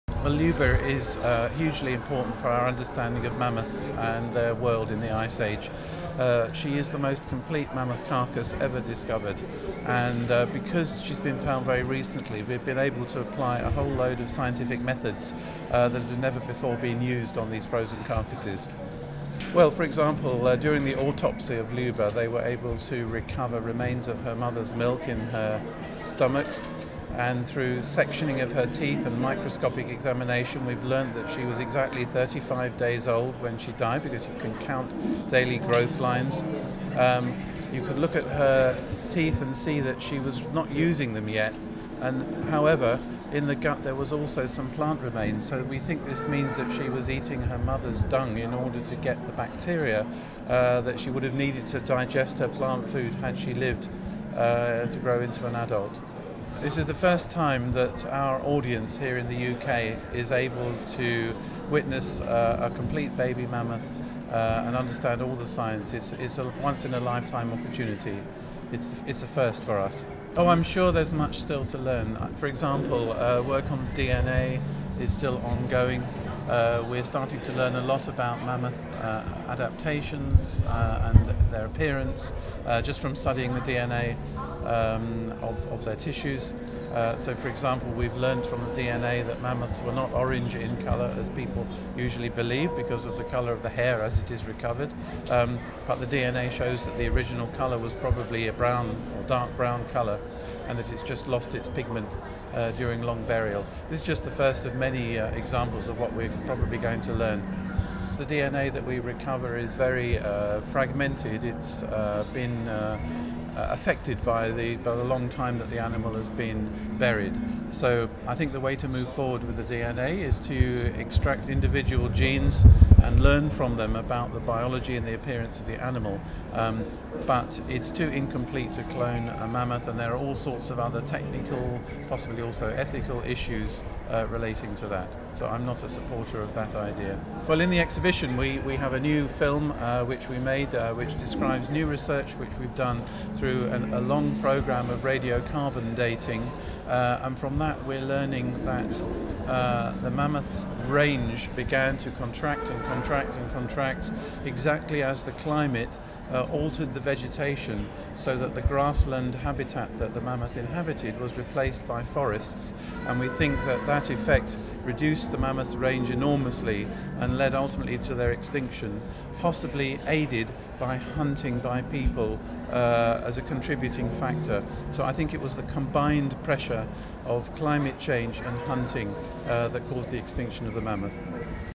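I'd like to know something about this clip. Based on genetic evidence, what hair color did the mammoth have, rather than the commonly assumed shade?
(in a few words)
Brown or dark brown.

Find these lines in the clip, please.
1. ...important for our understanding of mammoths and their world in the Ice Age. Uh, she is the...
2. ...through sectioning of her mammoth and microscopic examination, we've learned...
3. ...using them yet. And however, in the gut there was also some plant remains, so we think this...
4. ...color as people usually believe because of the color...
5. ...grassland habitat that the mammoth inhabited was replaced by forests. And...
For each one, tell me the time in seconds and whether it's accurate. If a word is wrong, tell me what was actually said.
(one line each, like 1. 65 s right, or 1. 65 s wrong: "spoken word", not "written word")
1. 1 s right
2. 27 s wrong: "teeth", not "mammoth"
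3. 40 s right
4. 90 s right
5. 158 s right.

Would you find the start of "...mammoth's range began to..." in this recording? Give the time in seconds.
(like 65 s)
150 s.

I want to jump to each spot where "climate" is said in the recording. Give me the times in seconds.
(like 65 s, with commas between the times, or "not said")
155 s, 177 s.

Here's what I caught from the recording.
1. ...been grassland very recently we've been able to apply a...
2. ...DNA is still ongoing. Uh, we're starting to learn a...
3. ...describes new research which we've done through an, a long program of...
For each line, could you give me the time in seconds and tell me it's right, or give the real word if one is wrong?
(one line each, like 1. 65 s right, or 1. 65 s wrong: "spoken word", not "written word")
1. 11 s wrong: "found", not "grassland"
2. 73 s right
3. 141 s right.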